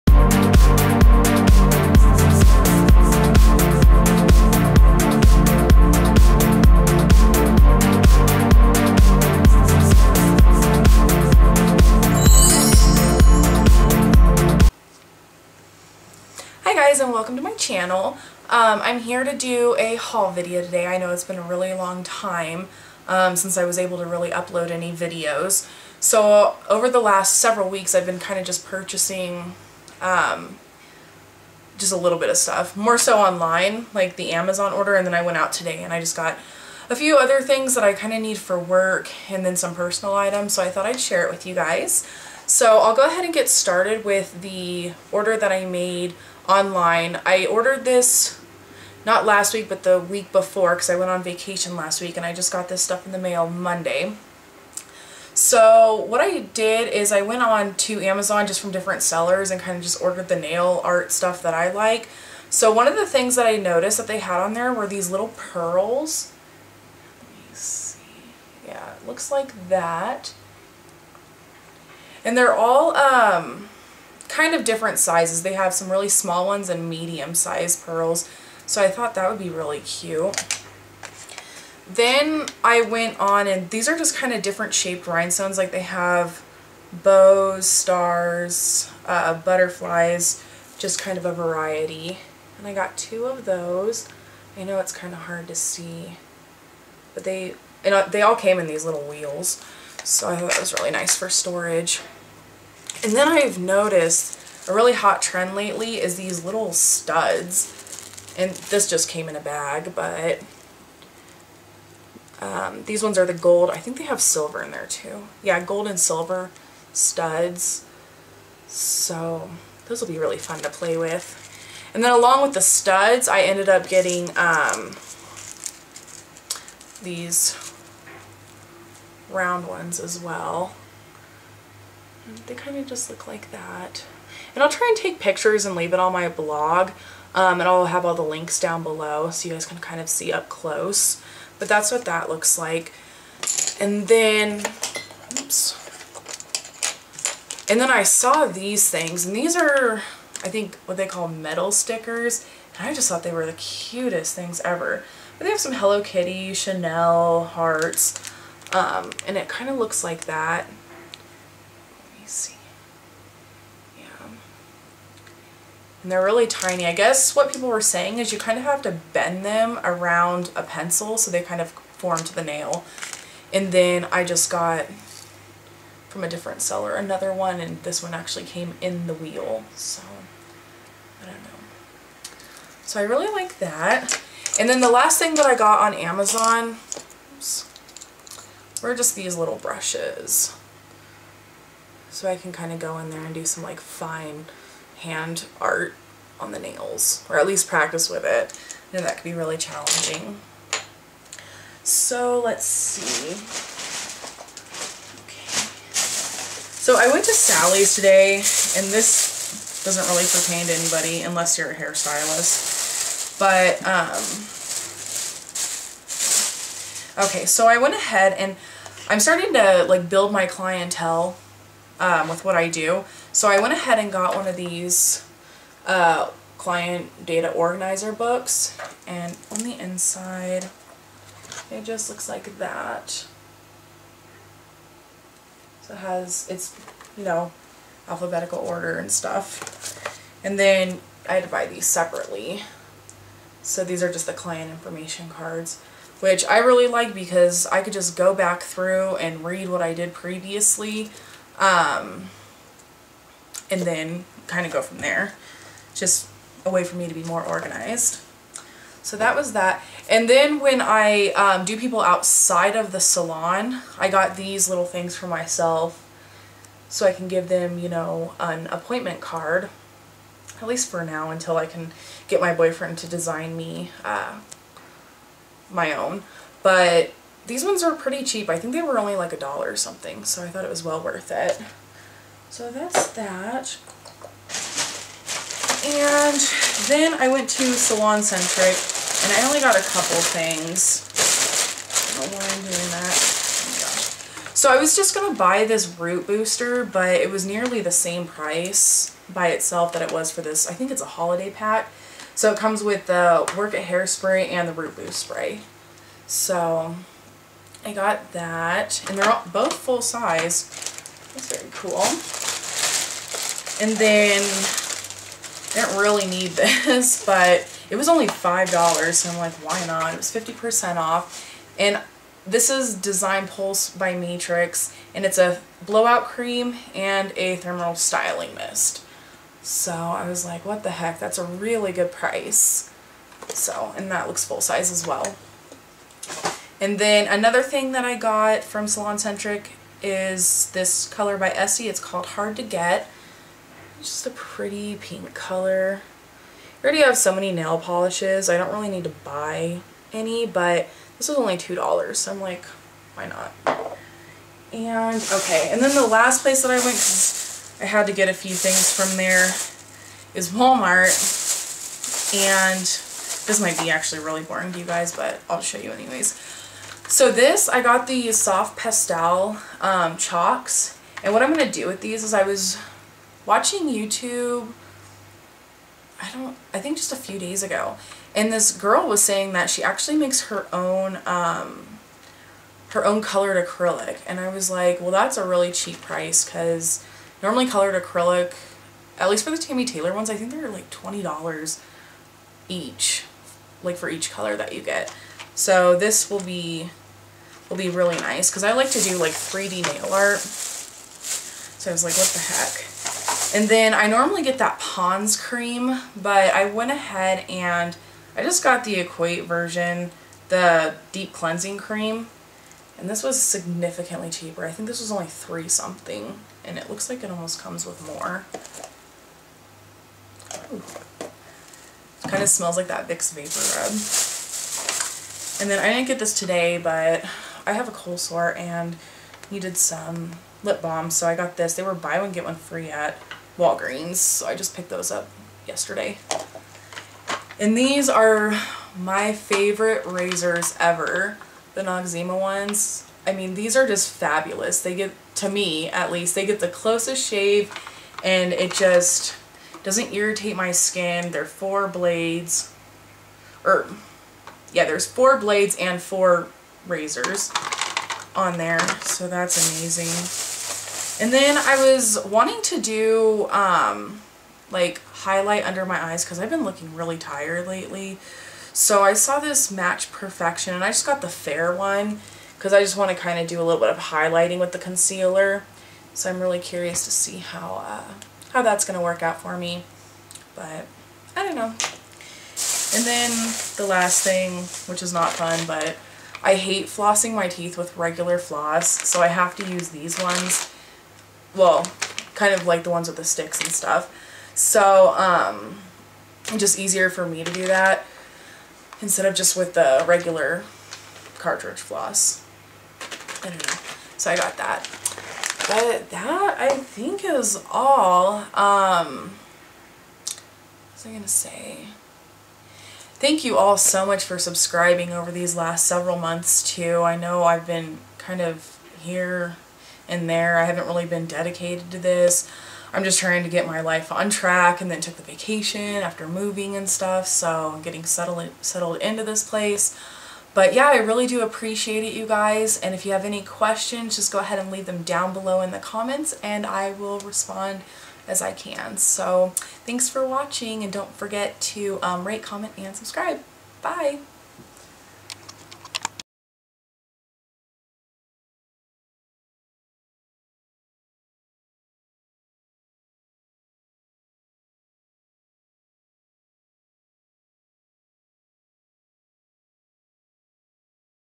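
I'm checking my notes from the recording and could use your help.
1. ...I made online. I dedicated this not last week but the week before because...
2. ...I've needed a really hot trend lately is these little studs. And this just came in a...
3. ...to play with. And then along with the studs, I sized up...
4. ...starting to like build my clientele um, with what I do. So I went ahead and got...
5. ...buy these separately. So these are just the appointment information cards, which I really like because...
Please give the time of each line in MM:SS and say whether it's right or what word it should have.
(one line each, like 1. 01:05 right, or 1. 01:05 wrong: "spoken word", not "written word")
1. 00:45 wrong: "ordered", not "dedicated"
2. 01:43 wrong: "noticed", not "needed"
3. 02:00 wrong: "ended", not "sized"
4. 03:39 right
5. 04:01 wrong: "client", not "appointment".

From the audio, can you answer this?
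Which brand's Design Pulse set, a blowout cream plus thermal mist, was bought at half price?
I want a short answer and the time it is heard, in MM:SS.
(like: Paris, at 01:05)
Matrix, at 05:24.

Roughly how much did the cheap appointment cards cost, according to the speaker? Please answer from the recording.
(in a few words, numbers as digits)
$1.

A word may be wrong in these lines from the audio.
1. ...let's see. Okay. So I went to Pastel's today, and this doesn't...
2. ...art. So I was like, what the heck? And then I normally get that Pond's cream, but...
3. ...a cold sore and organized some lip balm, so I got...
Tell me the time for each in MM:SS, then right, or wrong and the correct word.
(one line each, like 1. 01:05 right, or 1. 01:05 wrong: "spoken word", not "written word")
1. 03:22 wrong: "Sally", not "Pastel"
2. 06:40 right
3. 07:07 wrong: "needed", not "organized".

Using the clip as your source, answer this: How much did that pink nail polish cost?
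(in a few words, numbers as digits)
$2.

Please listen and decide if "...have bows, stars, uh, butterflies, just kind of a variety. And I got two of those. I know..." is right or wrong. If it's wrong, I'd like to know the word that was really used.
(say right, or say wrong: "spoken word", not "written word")
right.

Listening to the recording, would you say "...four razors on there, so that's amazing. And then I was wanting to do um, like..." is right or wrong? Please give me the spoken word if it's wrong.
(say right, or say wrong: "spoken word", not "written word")
right.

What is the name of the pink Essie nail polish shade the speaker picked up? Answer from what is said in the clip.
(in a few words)
Hard to Get.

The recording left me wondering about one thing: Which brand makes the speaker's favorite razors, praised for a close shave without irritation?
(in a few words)
Noxzema.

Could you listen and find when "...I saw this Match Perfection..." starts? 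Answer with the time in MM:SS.
07:49.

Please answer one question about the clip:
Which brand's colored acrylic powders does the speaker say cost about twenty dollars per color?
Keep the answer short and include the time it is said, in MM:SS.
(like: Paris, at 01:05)
Tammy Taylor, at 06:29.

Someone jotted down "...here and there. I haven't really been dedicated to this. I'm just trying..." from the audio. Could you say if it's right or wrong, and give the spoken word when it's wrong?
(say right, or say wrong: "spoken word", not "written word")
right.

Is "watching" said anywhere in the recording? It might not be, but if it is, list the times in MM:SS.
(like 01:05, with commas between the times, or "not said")
06:13, 09:00.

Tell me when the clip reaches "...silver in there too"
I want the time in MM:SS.
01:54.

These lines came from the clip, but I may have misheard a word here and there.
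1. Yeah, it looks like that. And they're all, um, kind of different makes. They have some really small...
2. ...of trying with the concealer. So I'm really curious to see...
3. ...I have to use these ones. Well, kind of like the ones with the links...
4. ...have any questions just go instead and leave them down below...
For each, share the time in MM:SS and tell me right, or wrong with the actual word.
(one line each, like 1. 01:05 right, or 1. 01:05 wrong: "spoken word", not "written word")
1. 01:08 wrong: "sizes", not "makes"
2. 07:53 wrong: "highlighting", not "trying"
3. 08:09 wrong: "sticks", not "links"
4. 08:53 wrong: "ahead", not "instead".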